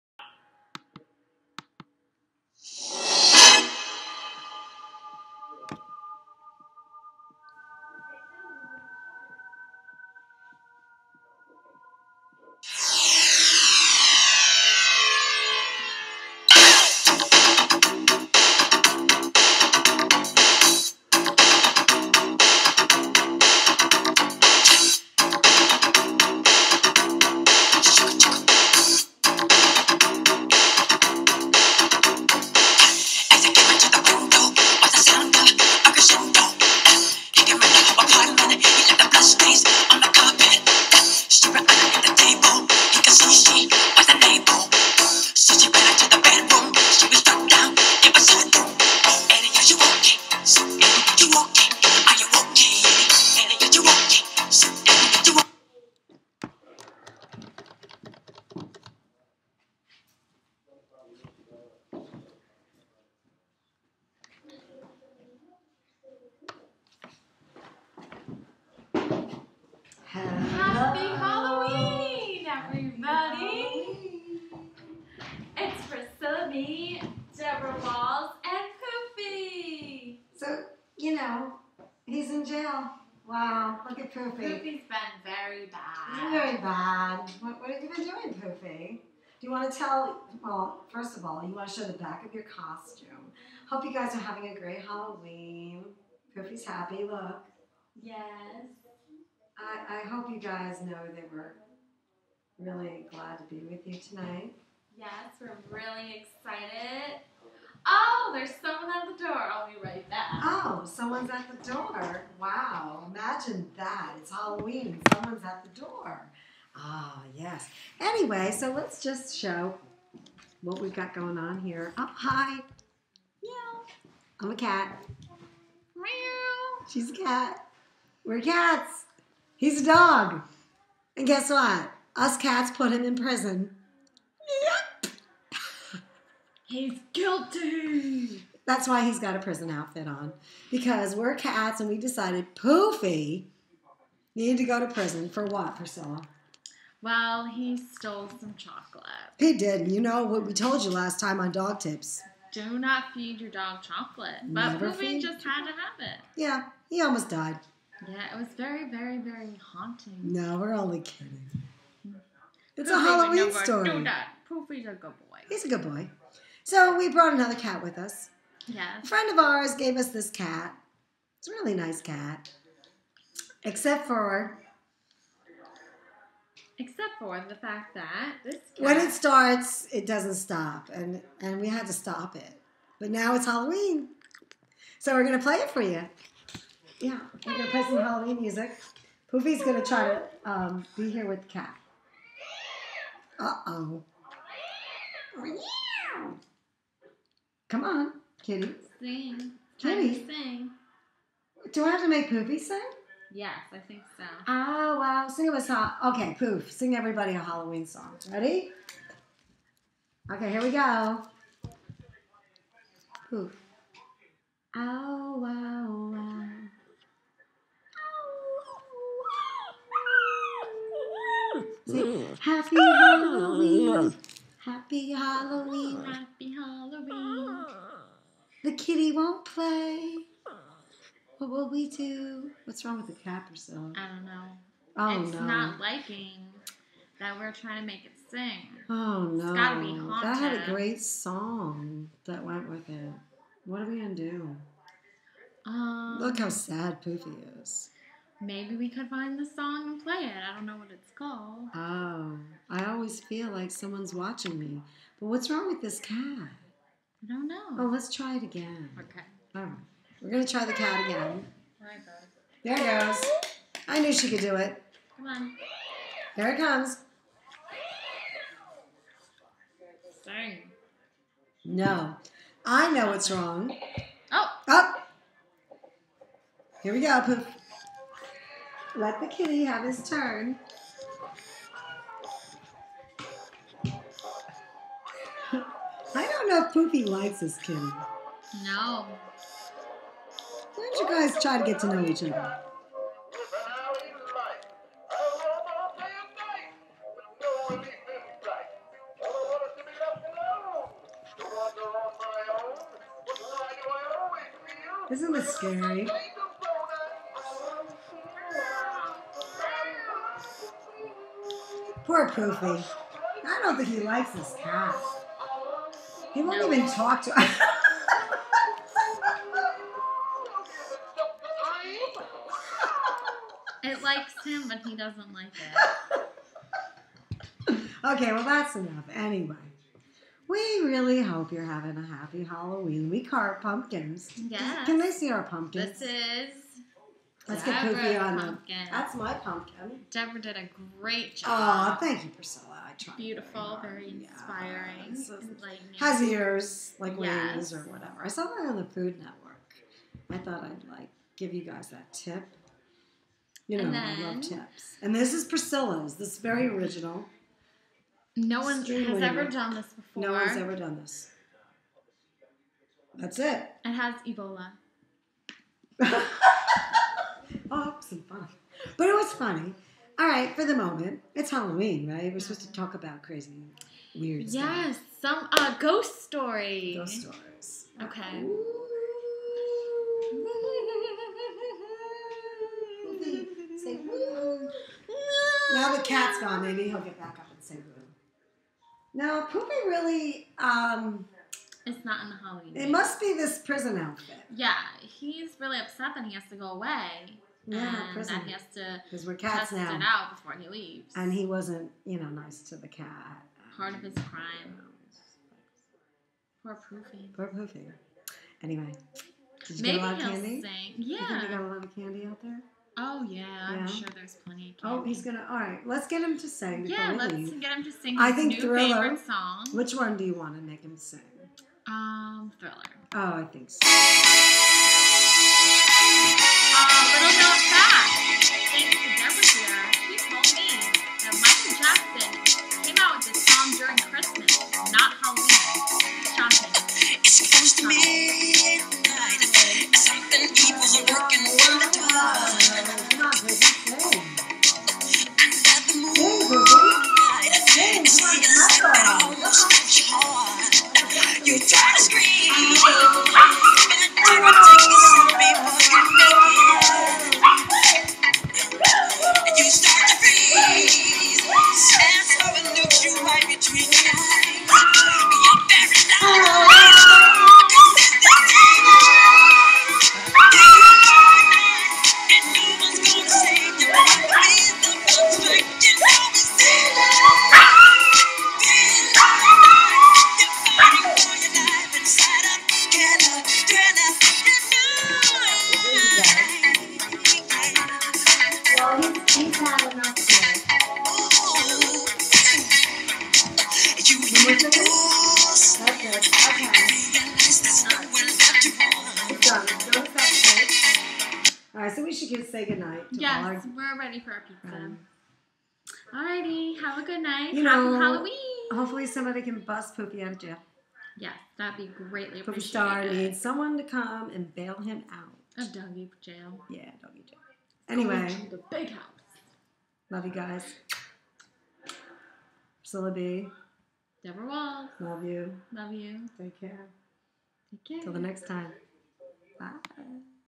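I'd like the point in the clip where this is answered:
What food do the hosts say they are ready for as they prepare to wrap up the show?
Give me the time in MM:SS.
08:24.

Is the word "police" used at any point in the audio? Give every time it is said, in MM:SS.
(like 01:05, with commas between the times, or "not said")
not said.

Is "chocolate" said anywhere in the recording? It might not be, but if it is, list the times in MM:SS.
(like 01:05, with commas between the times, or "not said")
02:28, 02:33.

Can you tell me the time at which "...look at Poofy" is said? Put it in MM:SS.
01:23.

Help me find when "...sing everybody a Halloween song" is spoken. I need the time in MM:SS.
03:26.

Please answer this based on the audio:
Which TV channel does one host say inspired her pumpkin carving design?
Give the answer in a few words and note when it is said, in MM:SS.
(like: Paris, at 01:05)
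Food Network, at 05:48.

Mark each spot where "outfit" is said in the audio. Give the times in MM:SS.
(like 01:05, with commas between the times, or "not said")
02:19, 06:33.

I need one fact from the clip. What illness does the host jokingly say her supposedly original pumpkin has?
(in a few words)
Ebola.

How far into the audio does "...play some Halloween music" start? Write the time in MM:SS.
03:07.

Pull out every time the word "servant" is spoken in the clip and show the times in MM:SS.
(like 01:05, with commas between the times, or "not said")
not said.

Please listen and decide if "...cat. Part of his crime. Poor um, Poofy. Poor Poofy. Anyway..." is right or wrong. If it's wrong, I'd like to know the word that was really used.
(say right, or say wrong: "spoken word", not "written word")
right.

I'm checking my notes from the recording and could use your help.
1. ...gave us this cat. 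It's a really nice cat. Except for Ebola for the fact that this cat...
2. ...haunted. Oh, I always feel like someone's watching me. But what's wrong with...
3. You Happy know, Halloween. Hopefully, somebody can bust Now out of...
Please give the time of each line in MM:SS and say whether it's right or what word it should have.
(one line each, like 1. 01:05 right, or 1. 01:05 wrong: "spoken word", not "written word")
1. 02:49 wrong: "Except", not "Ebola"
2. 04:11 wrong: "called", not "haunted"
3. 08:27 wrong: "Poofy", not "Now".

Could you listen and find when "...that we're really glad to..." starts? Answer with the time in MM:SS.
01:41.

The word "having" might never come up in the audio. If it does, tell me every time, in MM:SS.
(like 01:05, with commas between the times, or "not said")
01:34, 05:31.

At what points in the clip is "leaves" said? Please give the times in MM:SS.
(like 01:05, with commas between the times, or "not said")
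06:40, 06:57.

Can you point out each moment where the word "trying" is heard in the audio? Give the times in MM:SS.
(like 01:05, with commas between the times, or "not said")
03:57.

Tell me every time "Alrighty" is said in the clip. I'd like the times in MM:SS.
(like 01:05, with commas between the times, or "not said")
08:26.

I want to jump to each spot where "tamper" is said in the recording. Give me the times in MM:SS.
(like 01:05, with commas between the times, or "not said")
not said.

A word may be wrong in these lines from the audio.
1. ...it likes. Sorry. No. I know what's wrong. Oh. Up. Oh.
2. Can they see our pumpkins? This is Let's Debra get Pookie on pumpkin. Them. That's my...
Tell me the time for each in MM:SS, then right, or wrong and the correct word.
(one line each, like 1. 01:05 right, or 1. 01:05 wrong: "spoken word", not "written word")
1. 04:26 wrong: "comes", not "likes"
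2. 05:34 right.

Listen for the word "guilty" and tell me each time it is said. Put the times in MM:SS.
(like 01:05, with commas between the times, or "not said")
02:17.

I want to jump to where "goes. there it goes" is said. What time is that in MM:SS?
04:21.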